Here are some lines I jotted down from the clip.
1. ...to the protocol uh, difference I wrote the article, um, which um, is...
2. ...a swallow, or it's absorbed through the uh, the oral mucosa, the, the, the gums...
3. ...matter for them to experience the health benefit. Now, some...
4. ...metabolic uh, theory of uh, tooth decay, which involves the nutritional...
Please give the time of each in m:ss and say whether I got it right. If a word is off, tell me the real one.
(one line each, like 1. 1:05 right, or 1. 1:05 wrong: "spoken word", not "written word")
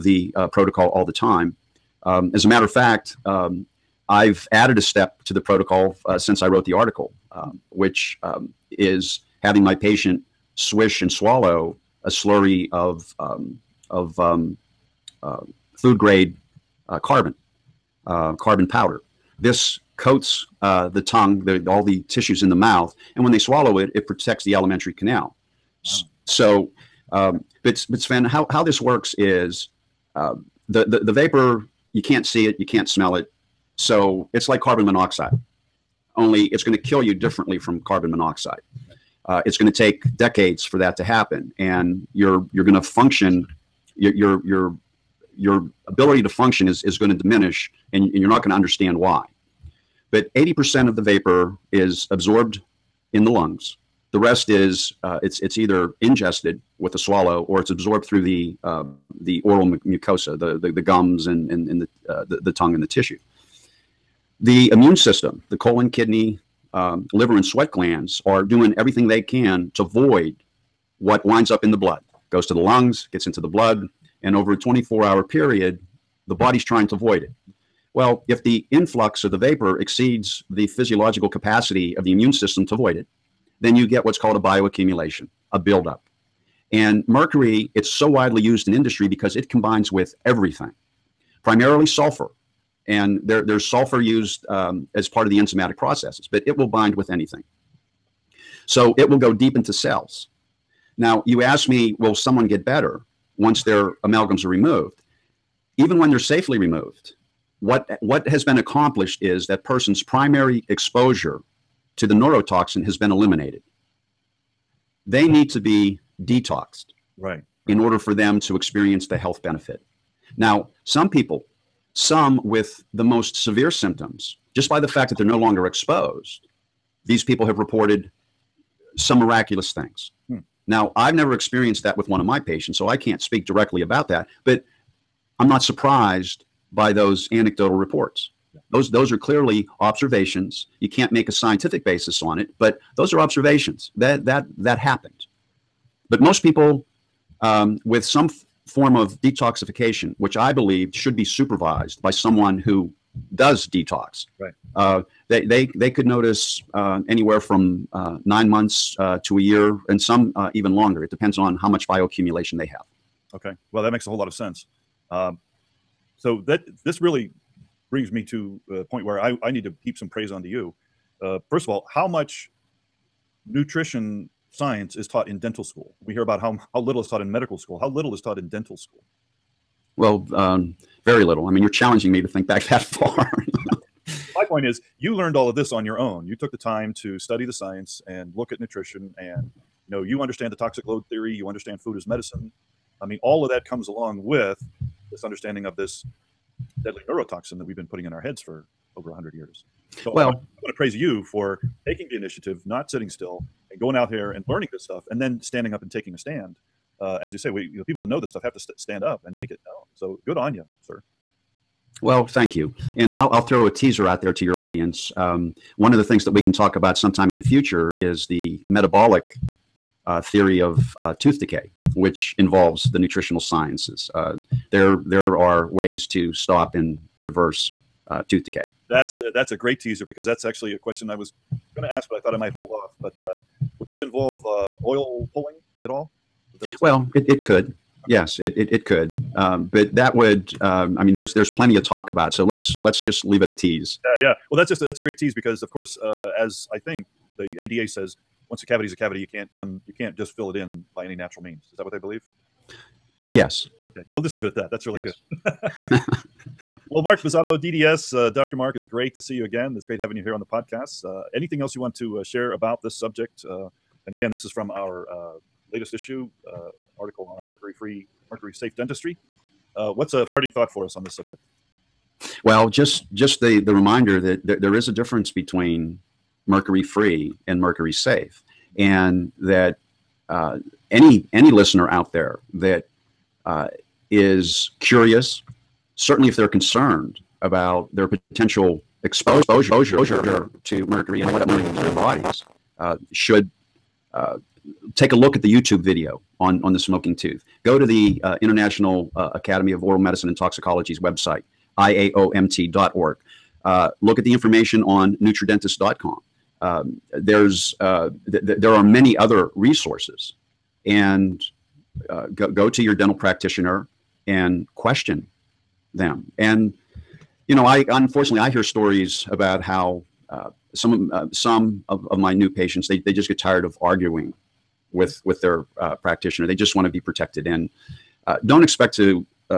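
1. 0:05 wrong: "since", not "difference"
2. 0:56 right
3. 1:57 wrong: "order", not "matter"
4. 3:38 right.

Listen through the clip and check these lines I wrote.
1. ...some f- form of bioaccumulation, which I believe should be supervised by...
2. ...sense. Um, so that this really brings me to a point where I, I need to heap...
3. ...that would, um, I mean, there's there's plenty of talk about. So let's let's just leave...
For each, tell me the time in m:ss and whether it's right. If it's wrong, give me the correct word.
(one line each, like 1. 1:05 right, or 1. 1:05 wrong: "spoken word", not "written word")
1. 2:28 wrong: "detoxification", not "bioaccumulation"
2. 2:44 right
3. 3:59 right.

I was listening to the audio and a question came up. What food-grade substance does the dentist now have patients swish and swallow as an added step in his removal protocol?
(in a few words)
carbon powder.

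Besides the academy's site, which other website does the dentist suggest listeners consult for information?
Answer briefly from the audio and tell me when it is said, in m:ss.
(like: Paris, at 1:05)
nutradentist.com, at 5:05.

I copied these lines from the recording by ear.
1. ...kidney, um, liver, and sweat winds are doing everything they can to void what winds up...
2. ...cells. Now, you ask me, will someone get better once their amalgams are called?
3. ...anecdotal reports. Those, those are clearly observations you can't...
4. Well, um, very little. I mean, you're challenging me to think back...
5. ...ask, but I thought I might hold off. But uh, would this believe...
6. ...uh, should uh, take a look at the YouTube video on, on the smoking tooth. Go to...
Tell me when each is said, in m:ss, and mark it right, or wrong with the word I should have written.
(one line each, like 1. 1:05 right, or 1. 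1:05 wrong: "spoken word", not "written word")
1. 1:05 wrong: "glands", not "winds"
2. 1:39 wrong: "removed", not "called"
3. 2:17 right
4. 2:59 right
5. 3:51 wrong: "involve", not "believe"
6. 4:52 right.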